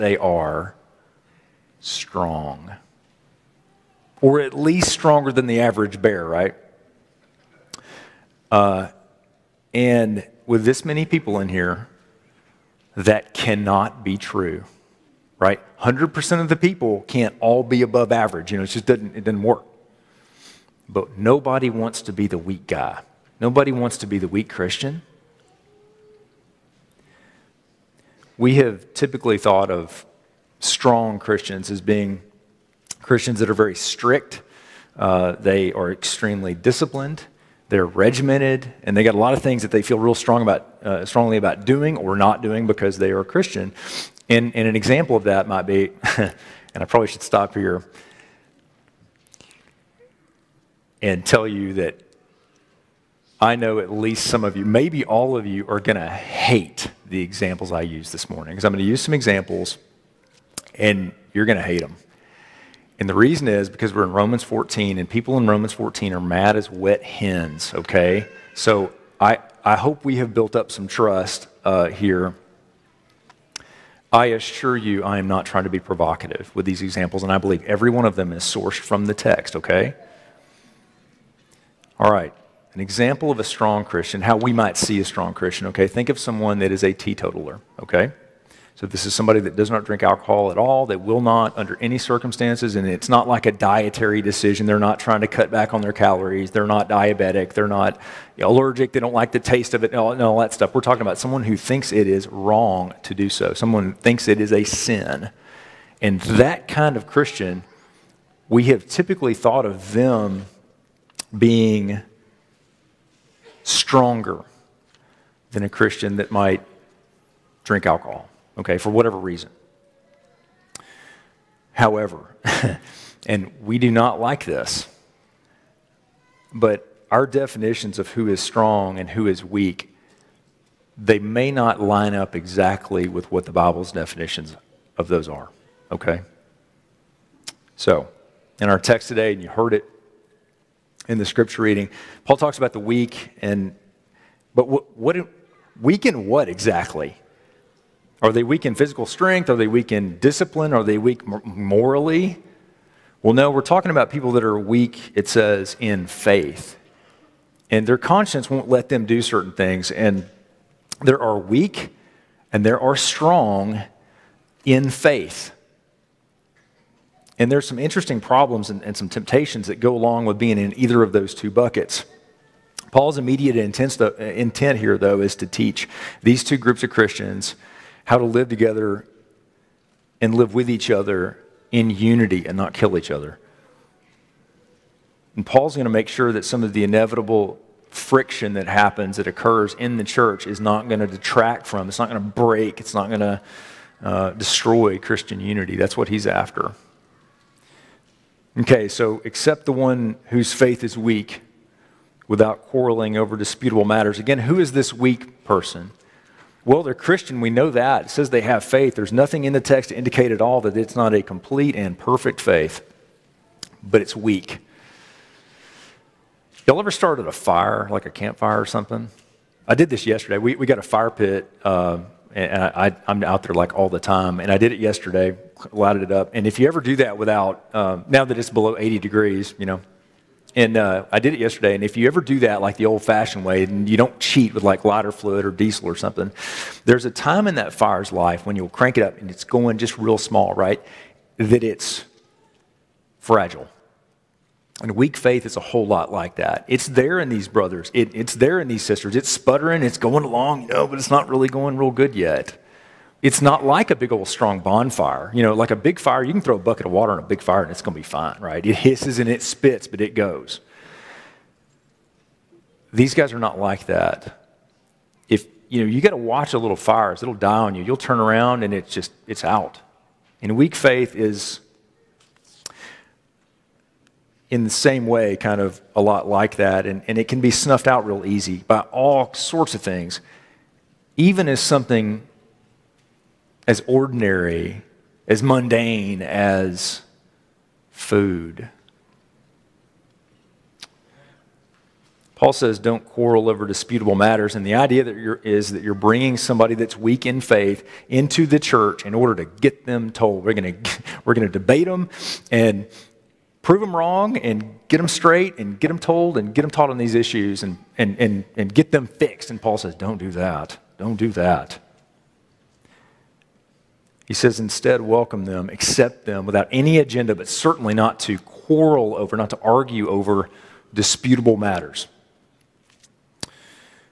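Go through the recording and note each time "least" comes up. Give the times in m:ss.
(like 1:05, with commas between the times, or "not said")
0:04, 0:53.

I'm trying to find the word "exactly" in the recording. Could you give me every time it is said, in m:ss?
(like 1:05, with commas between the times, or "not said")
2:12, 2:26.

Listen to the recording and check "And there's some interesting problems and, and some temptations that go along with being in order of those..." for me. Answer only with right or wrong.
wrong.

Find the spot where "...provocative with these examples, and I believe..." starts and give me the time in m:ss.
1:15.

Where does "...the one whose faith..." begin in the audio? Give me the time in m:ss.
3:19.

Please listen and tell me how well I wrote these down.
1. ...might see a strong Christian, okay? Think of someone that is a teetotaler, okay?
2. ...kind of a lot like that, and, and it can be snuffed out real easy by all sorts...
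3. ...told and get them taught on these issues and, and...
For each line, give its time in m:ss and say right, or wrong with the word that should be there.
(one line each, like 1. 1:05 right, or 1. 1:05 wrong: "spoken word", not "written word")
1. 1:24 right
2. 4:35 right
3. 5:05 right.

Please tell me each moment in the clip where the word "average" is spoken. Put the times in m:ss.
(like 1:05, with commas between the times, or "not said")
0:05, 0:18.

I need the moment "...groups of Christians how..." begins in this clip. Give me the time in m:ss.
2:56.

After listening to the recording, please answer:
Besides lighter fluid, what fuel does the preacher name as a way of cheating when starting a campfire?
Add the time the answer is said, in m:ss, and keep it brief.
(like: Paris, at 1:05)
diesel, at 3:55.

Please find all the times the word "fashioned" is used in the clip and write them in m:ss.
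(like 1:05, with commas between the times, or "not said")
3:53.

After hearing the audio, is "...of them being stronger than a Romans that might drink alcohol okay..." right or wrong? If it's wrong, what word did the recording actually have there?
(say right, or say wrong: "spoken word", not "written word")
wrong: "Christian", not "Romans".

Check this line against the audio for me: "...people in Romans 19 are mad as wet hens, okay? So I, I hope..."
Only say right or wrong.
wrong.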